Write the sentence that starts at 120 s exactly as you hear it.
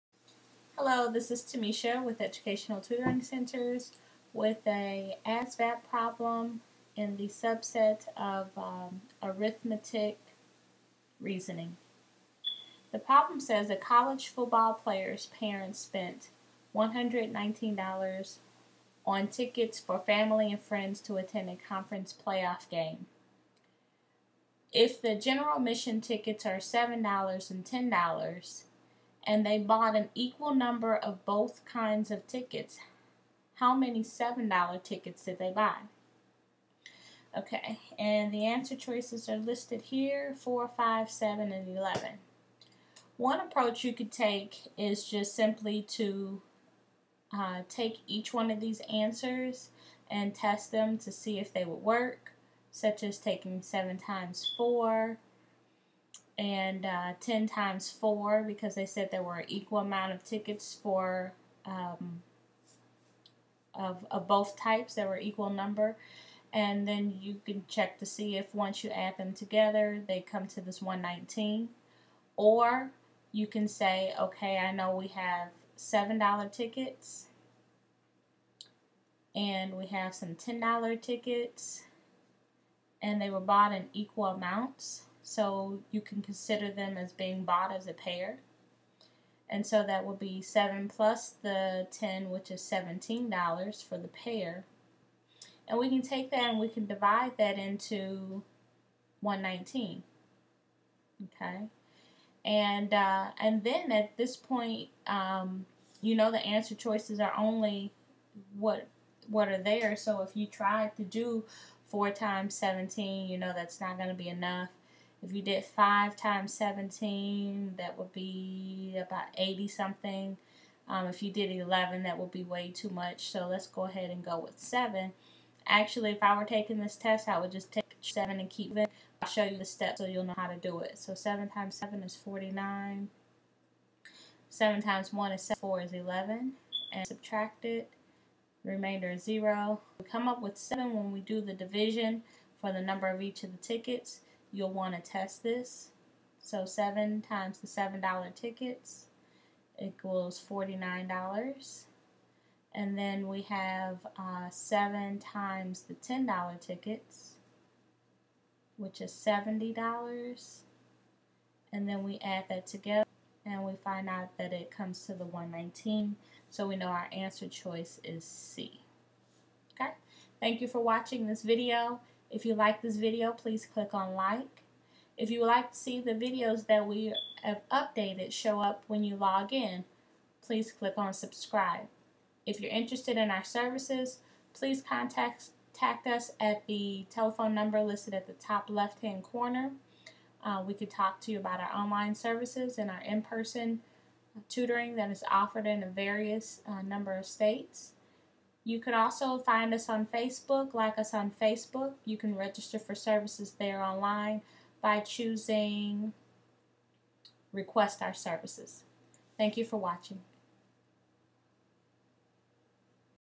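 Um, if you did 11, that would be way too much.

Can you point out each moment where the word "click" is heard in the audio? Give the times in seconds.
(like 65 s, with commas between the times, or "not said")
173 s, 180 s.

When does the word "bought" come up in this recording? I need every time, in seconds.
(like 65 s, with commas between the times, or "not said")
29 s, 83 s, 87 s.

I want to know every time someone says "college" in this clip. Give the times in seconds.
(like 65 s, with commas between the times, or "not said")
13 s.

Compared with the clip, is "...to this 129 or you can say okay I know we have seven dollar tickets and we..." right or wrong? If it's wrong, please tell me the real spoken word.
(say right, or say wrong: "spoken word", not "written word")
wrong: "119", not "129".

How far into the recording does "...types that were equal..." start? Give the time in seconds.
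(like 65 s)
64 s.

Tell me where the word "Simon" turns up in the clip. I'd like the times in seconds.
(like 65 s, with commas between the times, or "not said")
not said.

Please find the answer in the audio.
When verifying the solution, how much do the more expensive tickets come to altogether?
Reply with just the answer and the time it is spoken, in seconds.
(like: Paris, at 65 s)
$70, at 159 s.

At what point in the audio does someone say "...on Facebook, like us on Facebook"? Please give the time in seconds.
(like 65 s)
199 s.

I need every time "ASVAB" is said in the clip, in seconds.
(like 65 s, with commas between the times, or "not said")
5 s.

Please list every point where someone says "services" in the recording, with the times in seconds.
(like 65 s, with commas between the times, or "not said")
183 s, 192 s, 202 s, 208 s.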